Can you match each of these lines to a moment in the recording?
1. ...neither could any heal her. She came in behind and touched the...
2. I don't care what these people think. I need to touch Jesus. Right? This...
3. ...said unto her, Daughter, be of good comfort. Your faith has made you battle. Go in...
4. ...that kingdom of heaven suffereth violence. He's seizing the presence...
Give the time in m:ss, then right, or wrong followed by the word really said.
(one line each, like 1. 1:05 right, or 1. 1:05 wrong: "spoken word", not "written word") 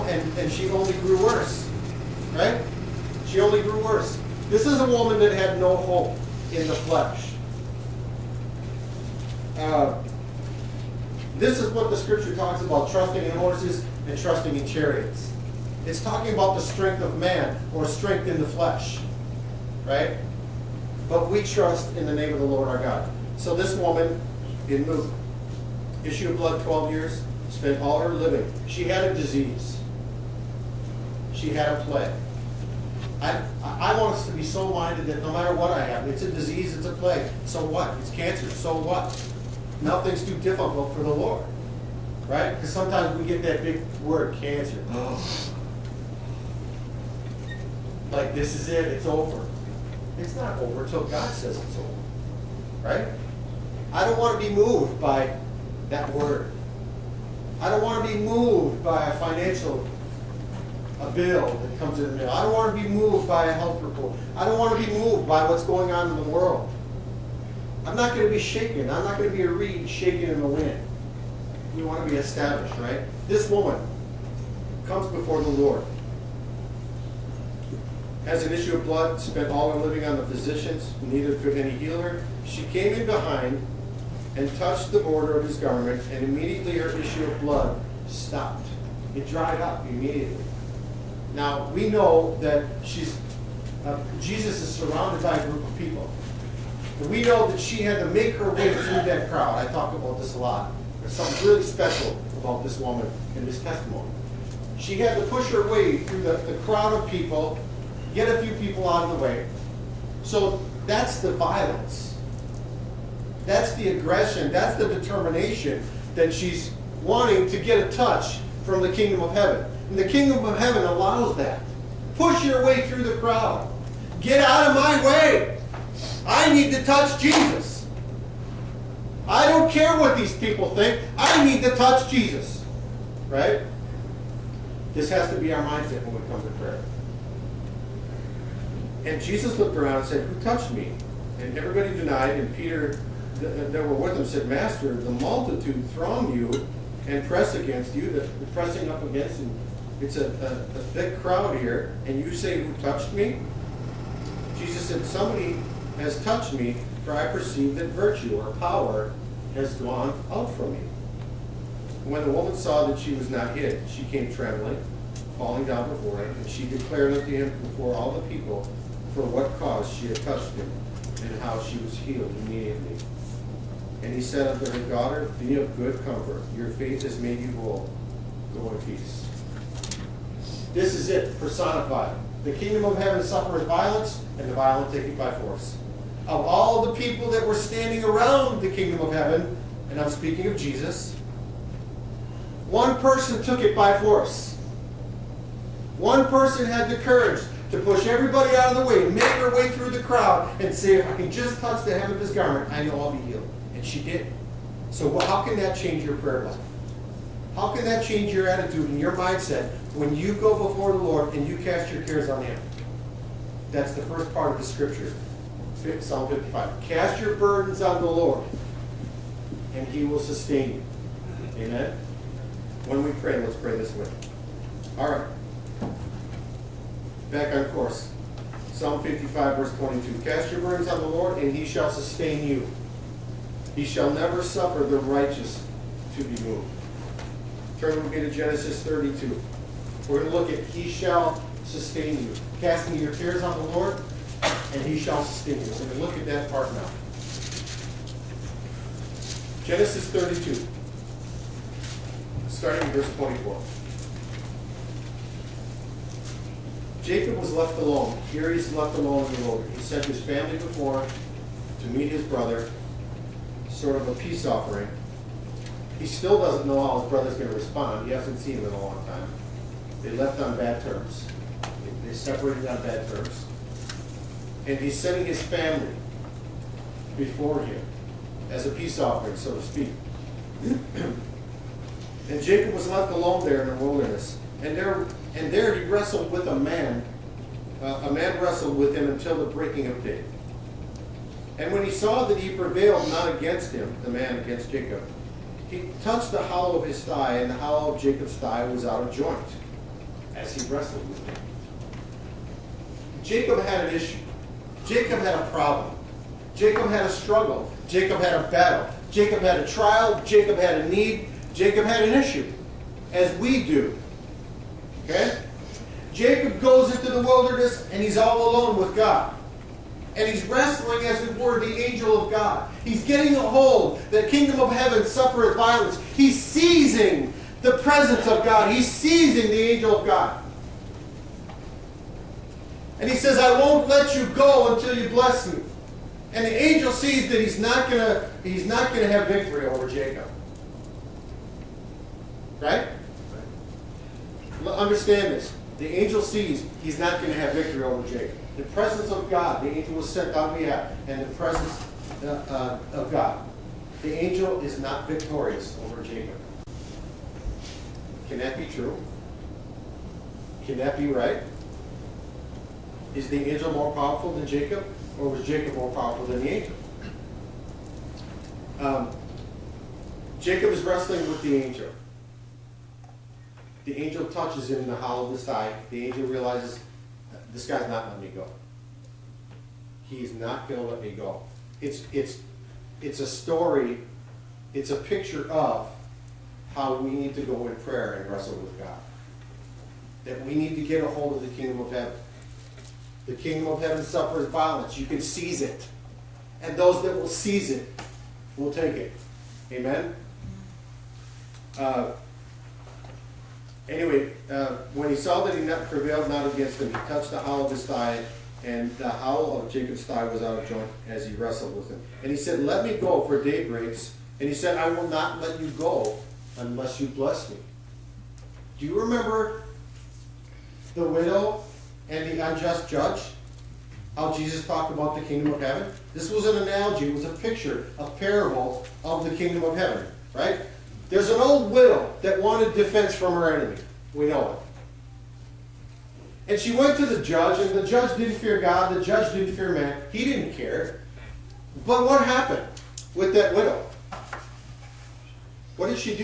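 1. 1:21 right
2. 2:09 right
3. 2:54 wrong: "whole", not "battle"
4. 5:24 right.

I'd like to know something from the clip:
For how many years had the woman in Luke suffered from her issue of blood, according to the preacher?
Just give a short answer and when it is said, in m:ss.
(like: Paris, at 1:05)
12 years, at 0:26.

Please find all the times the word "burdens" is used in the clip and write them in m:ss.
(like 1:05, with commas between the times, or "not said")
3:37, 3:50.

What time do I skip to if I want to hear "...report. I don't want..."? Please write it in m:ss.
1:03.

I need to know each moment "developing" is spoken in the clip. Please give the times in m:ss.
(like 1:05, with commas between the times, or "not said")
not said.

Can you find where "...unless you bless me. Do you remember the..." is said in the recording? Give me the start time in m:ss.
6:56.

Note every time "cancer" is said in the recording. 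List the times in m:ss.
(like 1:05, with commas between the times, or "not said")
0:38, 0:44.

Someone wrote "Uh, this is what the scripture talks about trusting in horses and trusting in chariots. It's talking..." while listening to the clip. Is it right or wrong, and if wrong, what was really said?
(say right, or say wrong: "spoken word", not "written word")
right.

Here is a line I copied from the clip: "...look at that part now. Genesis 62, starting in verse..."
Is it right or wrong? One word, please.
wrong.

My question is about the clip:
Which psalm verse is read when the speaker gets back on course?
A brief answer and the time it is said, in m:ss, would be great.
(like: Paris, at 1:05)
22, at 3:49.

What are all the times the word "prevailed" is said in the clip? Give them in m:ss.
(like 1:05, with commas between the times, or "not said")
4:52, 6:45.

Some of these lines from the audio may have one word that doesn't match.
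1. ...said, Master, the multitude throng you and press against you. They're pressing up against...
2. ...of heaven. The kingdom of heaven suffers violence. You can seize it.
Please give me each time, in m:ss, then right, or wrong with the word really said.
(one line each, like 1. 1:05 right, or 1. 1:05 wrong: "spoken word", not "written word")
1. 2:24 right
2. 6:31 right.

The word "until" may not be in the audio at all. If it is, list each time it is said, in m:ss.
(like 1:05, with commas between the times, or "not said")
0:50, 4:49, 5:34.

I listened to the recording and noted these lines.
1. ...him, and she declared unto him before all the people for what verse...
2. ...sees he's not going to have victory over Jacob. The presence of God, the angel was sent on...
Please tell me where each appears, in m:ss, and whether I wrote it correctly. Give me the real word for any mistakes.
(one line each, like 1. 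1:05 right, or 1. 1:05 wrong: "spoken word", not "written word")
1. 2:46 wrong: "cause", not "verse"
2. 5:46 right.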